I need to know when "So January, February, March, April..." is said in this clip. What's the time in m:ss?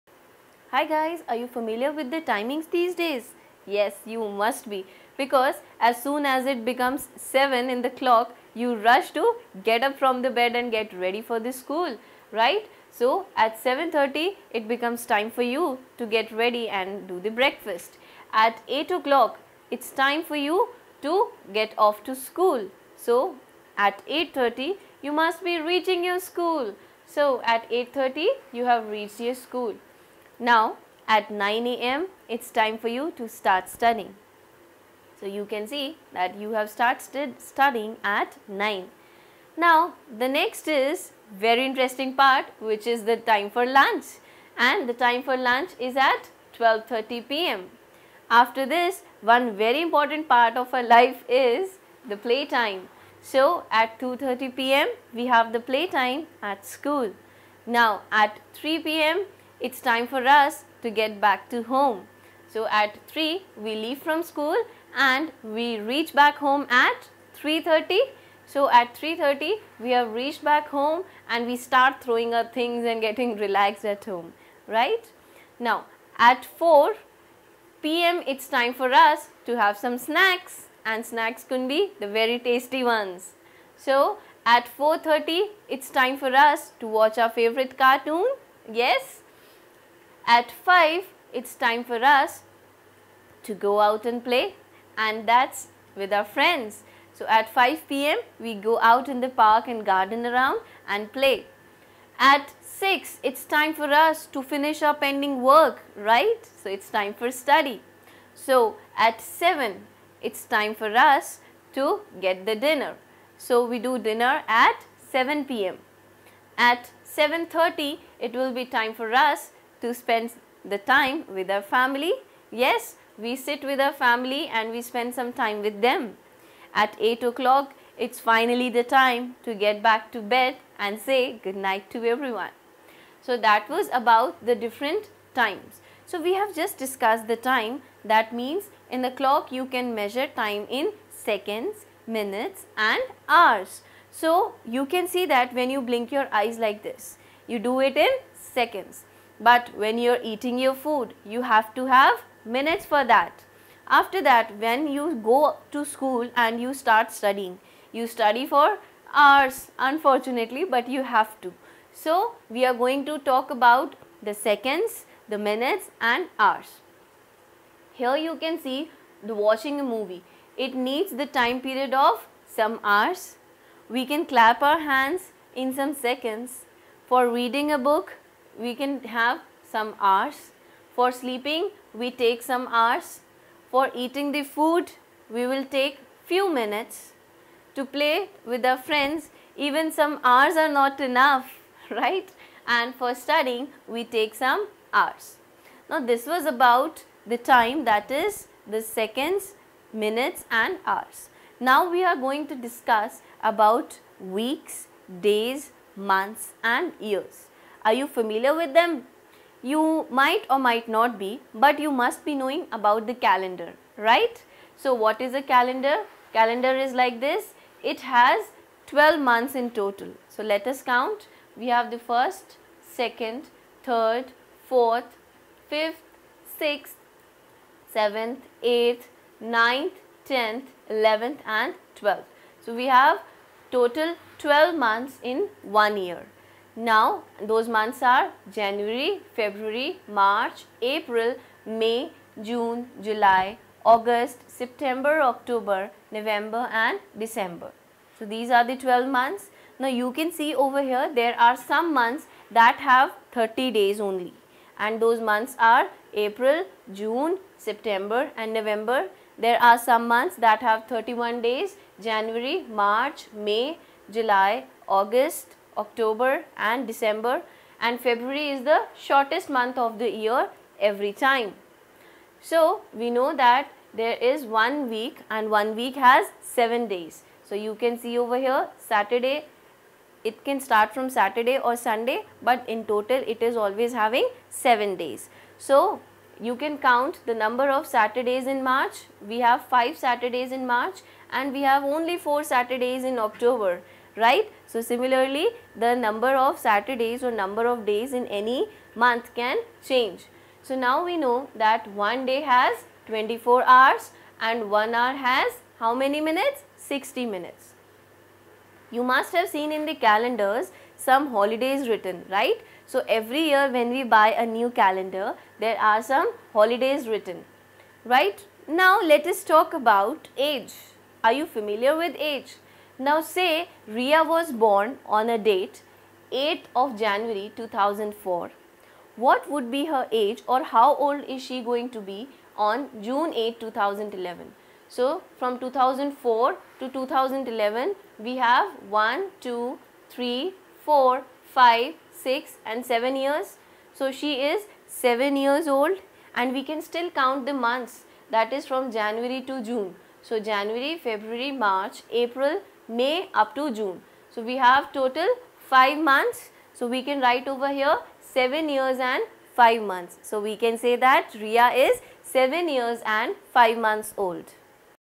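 5:50.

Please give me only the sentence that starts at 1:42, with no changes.
At 6, it's time for us to finish our pending work, right?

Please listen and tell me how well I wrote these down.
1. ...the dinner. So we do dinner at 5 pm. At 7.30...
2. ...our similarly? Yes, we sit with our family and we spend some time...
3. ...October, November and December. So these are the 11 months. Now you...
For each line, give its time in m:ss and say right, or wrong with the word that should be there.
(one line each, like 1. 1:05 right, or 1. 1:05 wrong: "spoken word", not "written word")
1. 1:52 wrong: "7", not "5"
2. 2:01 wrong: "family", not "similarly"
3. 4:05 wrong: "12", not "11".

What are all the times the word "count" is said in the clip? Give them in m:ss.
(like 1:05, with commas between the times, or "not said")
3:40, 4:46, 5:47.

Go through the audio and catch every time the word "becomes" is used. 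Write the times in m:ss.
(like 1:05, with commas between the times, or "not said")
0:06, 0:14.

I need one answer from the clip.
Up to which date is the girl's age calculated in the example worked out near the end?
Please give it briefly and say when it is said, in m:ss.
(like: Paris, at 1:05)
June 8, 2011, at 5:33.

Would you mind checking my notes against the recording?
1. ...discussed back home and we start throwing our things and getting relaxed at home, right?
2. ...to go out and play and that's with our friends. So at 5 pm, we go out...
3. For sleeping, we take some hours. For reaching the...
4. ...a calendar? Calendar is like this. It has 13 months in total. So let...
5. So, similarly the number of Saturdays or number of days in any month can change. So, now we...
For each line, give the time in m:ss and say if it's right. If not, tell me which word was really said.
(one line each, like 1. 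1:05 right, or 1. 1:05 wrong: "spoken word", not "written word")
1. 1:10 wrong: "reached", not "discussed"
2. 1:33 right
3. 3:00 wrong: "eating", not "reaching"
4. 3:35 wrong: "12", not "13"
5. 4:54 right.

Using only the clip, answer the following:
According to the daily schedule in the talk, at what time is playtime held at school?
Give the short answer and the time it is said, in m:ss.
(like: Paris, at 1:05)
2:30 p.m., at 0:53.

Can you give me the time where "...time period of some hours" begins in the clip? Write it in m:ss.
2:51.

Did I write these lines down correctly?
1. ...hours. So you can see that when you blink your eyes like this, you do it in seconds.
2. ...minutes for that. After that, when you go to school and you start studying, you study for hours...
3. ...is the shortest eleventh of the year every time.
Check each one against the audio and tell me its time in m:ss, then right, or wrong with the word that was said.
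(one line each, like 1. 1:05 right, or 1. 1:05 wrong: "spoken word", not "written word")
1. 2:23 right
2. 2:32 right
3. 4:28 wrong: "month", not "eleventh".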